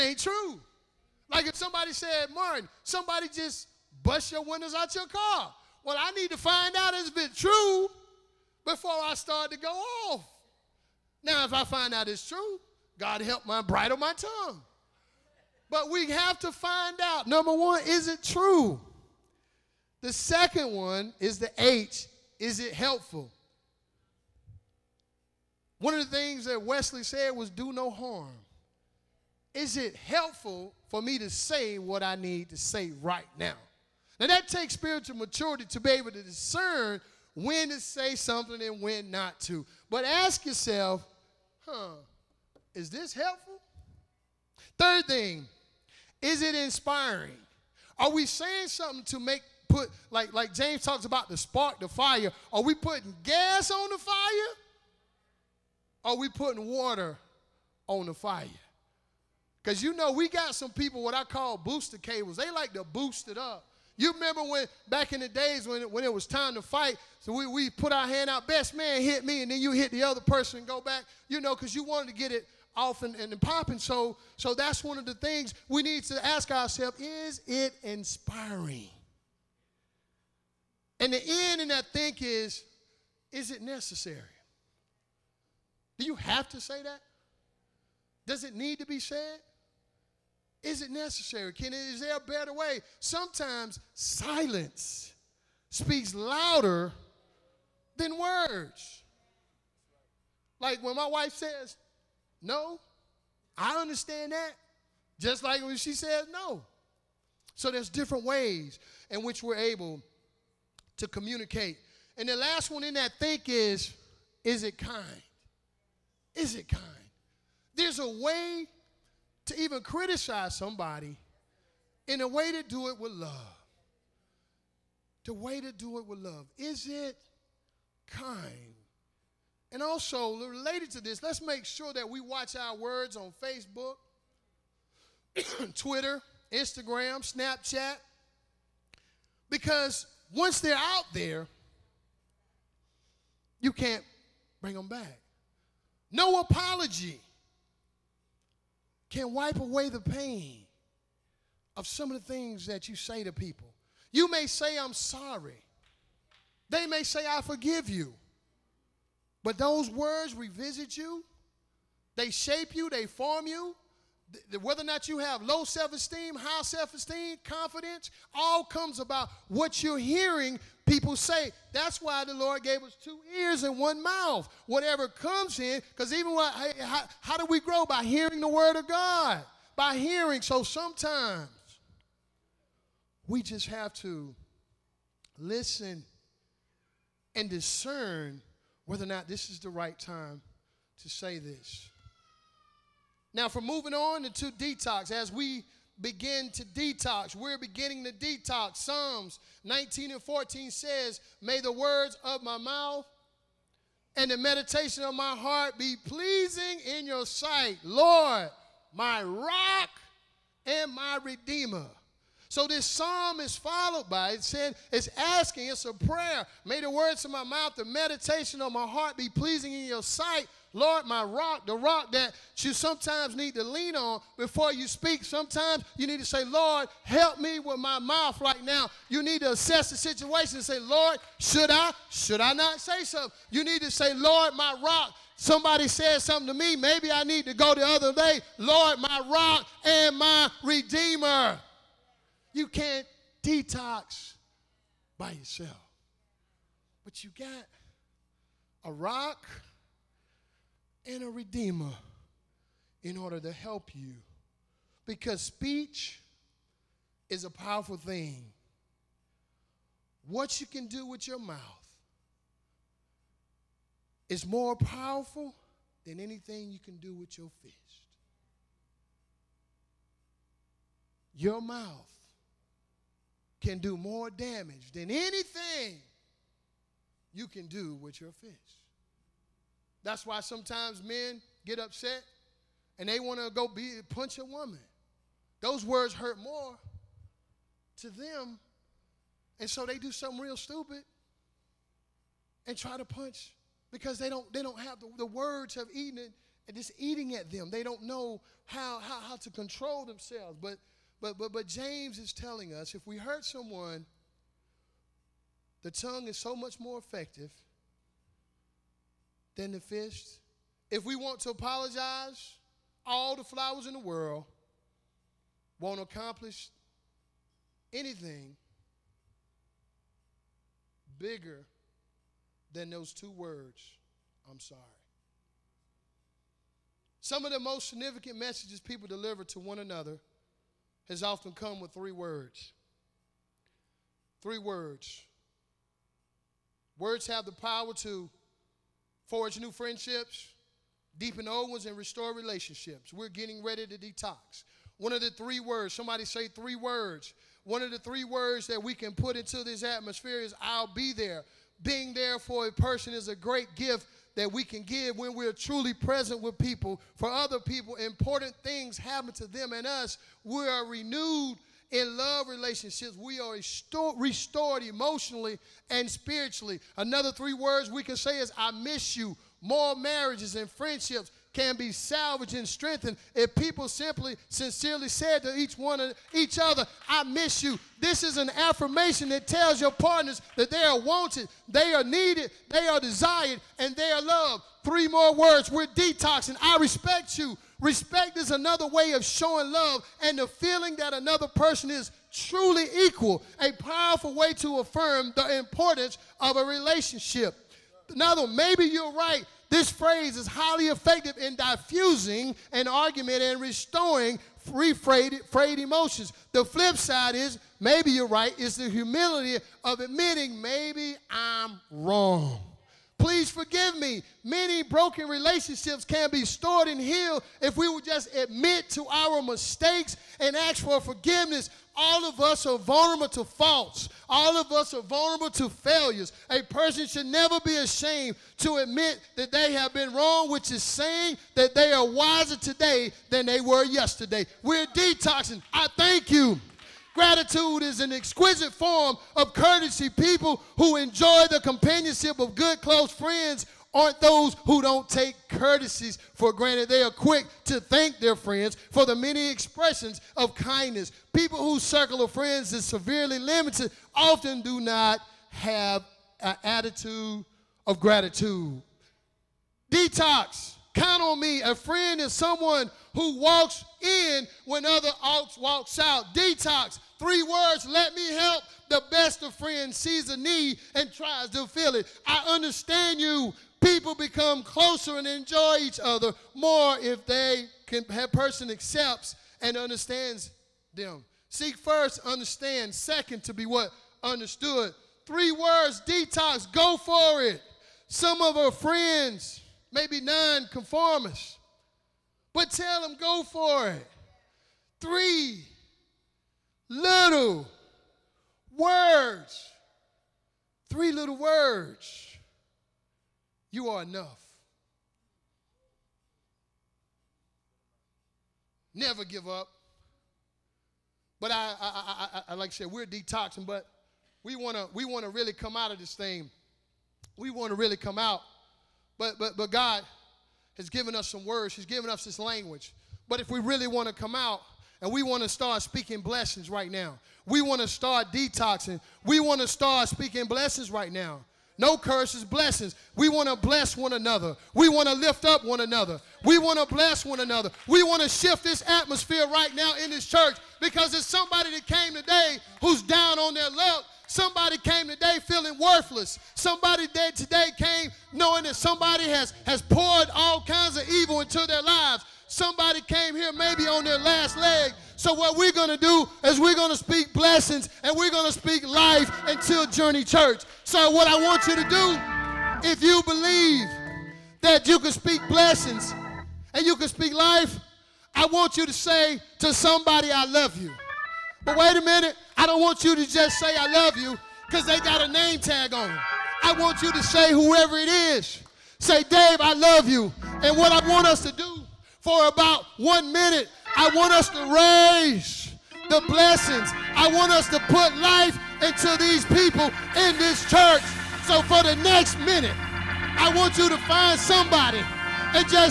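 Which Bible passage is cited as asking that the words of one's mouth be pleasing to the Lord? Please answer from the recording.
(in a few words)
Psalms 19:14.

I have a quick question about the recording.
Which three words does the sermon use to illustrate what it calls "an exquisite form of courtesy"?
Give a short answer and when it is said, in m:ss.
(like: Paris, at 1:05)
I thank you, at 7:15.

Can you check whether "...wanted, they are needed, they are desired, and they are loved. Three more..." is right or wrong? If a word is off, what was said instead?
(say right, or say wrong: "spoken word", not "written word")
right.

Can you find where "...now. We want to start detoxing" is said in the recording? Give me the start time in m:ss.
8:46.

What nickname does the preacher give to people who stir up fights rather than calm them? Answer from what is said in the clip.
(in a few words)
booster cables.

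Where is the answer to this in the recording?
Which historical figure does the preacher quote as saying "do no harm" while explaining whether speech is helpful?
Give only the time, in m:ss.
0:26.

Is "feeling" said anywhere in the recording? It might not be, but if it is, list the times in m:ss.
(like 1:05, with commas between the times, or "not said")
6:30, 9:05.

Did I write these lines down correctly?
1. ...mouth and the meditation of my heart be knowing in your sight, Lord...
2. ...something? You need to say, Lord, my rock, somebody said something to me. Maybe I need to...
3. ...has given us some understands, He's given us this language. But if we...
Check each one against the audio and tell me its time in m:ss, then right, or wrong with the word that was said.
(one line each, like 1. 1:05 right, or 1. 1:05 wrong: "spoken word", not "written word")
1. 3:22 wrong: "pleasing", not "knowing"
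2. 3:53 right
3. 8:40 wrong: "words", not "understands".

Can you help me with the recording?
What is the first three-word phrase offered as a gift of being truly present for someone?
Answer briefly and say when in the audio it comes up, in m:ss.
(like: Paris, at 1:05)
I'll be there, at 5:50.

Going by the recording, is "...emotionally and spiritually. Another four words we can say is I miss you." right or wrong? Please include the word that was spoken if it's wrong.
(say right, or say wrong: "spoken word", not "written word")
wrong: "three", not "four".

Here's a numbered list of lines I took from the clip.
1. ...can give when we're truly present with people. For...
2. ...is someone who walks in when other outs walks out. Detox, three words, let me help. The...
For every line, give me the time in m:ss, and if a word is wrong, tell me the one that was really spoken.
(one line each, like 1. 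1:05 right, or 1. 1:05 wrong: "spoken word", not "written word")
1. 5:54 right
2. 7:42 right.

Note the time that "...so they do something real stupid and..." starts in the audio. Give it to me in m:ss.
4:49.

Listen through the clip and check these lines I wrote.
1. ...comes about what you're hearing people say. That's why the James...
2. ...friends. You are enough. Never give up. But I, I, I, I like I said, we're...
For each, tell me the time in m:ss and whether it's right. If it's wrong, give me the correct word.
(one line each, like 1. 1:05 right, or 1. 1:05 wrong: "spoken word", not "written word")
1. 2:48 wrong: "Lord", not "James"
2. 8:21 wrong: "words", not "friends".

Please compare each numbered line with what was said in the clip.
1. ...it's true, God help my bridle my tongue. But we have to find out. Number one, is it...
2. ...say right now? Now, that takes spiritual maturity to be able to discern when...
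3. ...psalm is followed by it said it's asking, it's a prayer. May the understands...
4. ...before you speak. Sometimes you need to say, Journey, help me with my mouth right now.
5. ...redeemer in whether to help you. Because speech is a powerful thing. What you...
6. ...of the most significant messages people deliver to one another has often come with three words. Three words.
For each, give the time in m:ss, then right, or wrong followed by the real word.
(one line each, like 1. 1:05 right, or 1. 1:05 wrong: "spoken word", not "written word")
1. 0:12 right
2. 0:32 right
3. 3:32 wrong: "words", not "understands"
4. 3:44 wrong: "Lord", not "Journey"
5. 4:11 wrong: "order", not "whether"
6. 5:27 right.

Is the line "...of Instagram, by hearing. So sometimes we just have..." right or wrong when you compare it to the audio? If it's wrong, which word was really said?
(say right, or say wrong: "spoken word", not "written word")
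wrong: "God", not "Instagram".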